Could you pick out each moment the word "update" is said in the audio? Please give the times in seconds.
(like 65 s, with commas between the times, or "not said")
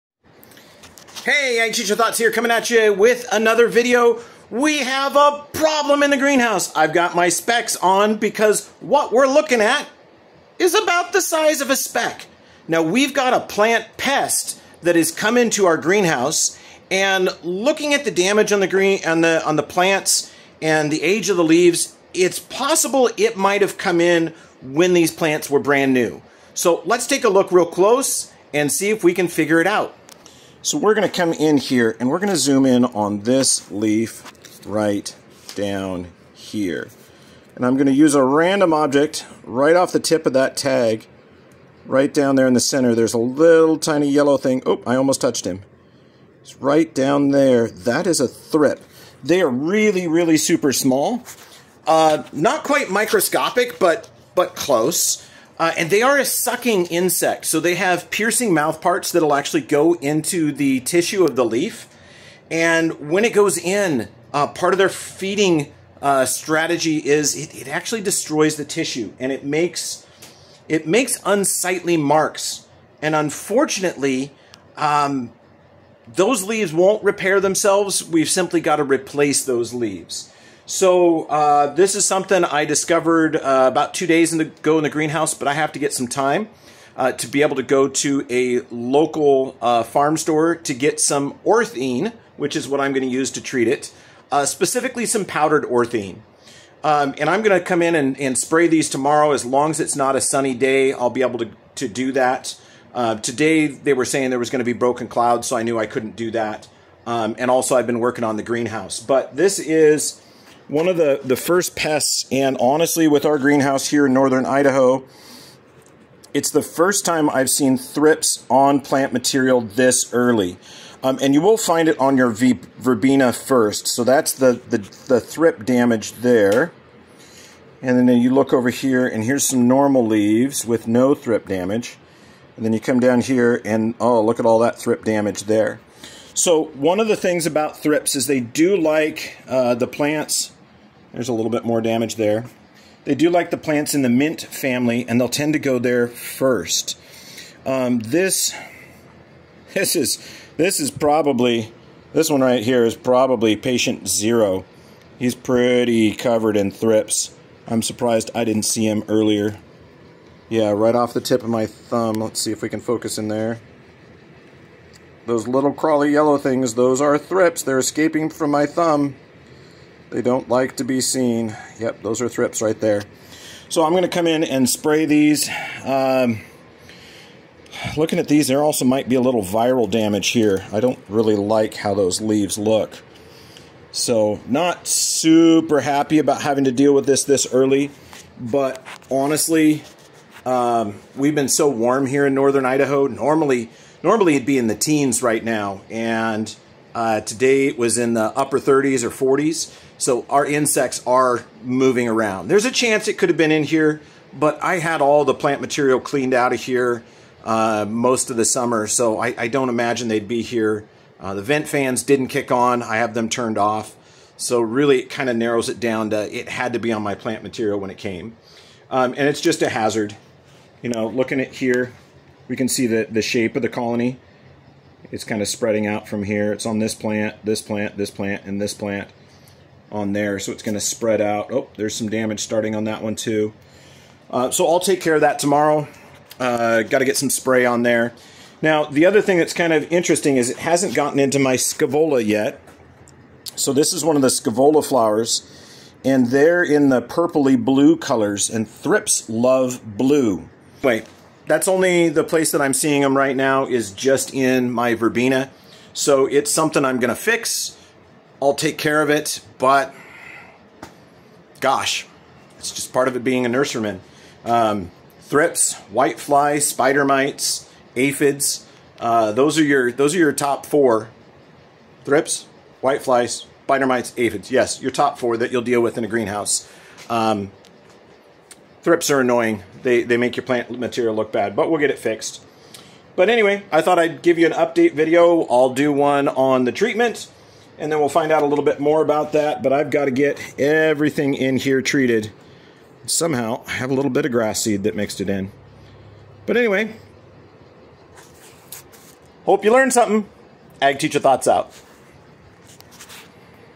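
284 s.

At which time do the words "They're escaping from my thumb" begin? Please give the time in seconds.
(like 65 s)
167 s.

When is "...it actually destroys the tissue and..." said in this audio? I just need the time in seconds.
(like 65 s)
67 s.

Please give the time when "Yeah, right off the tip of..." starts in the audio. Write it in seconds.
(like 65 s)
160 s.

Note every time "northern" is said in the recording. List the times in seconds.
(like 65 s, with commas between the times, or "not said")
114 s, 192 s.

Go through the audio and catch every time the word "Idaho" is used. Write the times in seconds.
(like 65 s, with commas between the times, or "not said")
114 s, 192 s.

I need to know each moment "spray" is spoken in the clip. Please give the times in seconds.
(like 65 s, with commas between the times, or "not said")
98 s, 174 s, 237 s.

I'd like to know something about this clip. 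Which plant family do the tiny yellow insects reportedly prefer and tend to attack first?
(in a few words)
mint family.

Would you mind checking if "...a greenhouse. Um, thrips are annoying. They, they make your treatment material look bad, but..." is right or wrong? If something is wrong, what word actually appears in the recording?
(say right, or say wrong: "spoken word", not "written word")
wrong: "plant", not "treatment".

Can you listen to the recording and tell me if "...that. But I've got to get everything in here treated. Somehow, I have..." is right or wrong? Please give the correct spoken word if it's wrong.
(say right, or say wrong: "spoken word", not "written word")
right.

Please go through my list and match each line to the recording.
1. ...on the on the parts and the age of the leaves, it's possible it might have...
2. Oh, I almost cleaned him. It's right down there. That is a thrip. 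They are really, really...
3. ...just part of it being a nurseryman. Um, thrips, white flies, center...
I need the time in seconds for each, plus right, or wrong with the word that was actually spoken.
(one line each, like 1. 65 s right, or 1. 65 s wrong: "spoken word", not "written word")
1. 19 s wrong: "plants", not "parts"
2. 44 s wrong: "touched", not "cleaned"
3. 262 s wrong: "spider", not "center".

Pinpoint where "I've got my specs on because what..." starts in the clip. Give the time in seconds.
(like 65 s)
6 s.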